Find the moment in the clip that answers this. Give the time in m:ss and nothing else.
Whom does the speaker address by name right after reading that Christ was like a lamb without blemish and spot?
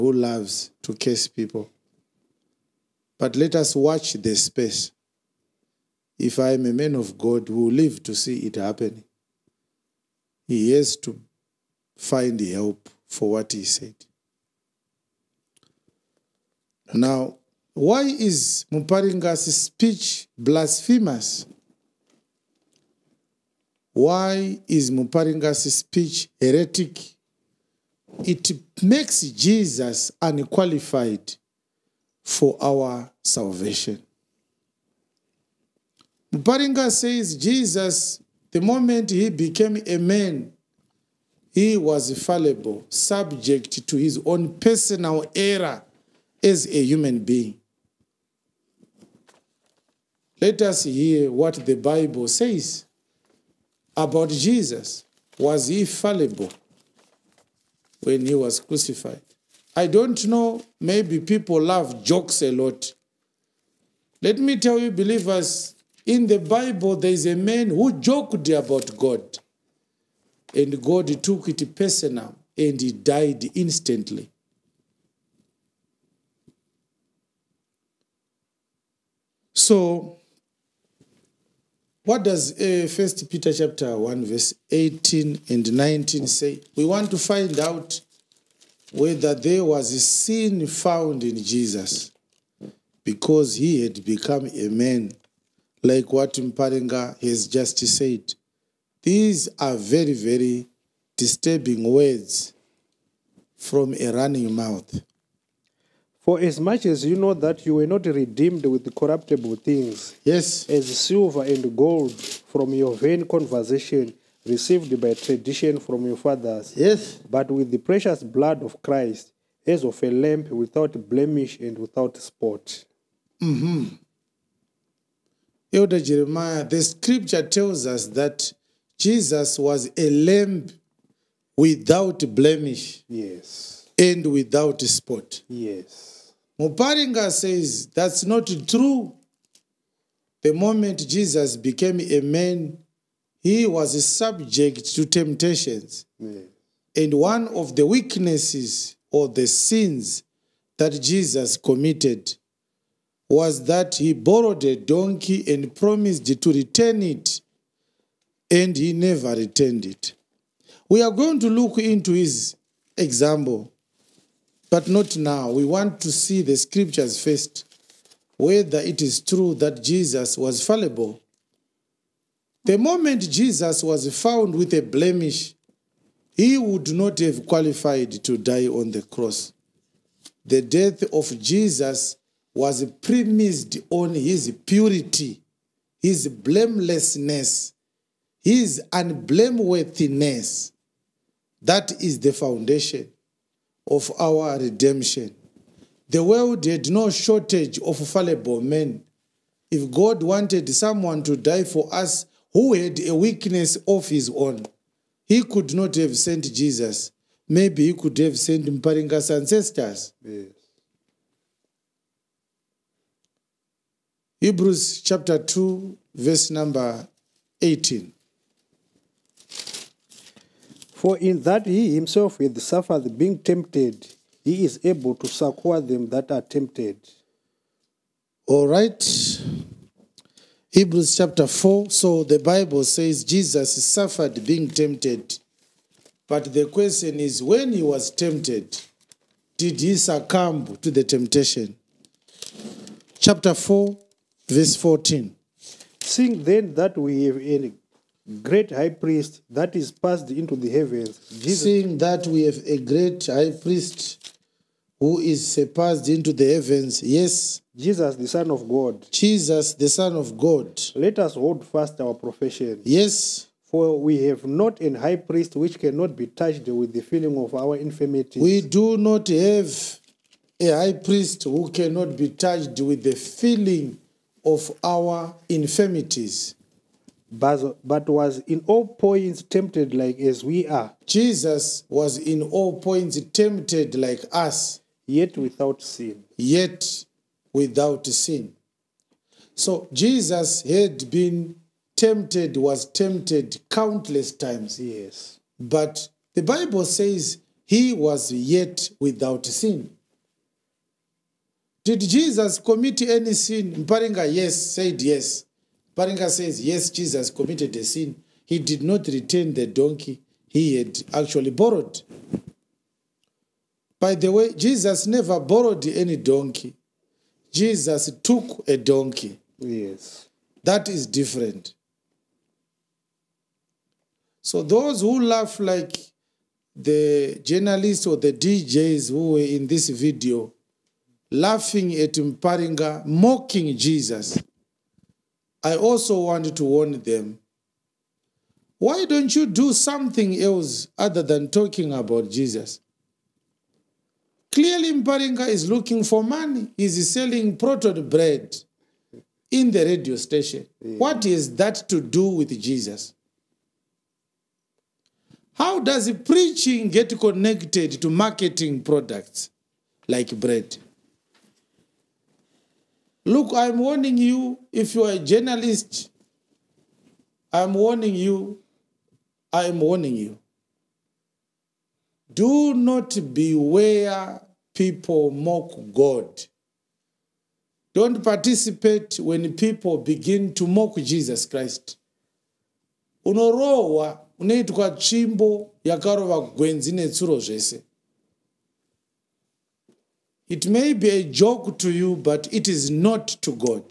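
2:05.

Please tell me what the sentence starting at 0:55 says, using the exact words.
Was he fallible when he was crucified?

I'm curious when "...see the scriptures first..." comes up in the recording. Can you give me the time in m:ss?
2:46.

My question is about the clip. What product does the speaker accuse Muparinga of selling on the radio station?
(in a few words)
Prototype bread.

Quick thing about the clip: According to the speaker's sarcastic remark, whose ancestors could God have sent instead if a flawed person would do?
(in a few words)
Mparinga's ancestors.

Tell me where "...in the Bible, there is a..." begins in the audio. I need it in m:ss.
1:06.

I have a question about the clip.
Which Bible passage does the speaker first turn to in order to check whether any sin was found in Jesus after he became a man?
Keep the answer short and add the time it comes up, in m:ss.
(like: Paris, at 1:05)
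1 Peter 1:18-19, at 1:22.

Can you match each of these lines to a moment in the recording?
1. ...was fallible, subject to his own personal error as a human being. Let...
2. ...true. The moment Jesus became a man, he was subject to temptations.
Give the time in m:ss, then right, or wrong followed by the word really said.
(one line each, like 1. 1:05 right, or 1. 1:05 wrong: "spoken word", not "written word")
1. 0:41 right
2. 2:18 right.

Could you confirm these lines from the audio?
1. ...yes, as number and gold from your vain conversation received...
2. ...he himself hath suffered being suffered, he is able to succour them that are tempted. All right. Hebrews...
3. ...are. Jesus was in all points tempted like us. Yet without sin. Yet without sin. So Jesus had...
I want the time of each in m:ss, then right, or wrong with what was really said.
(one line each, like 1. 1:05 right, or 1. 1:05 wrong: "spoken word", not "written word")
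1. 1:50 wrong: "silver", not "number"
2. 3:41 wrong: "tempted", not "suffered"
3. 4:40 right.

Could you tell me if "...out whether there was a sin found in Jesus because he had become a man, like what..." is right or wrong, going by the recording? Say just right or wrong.
right.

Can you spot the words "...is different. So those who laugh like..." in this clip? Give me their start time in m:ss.
5:20.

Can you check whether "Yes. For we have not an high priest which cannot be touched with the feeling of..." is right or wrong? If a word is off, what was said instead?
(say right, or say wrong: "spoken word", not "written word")
right.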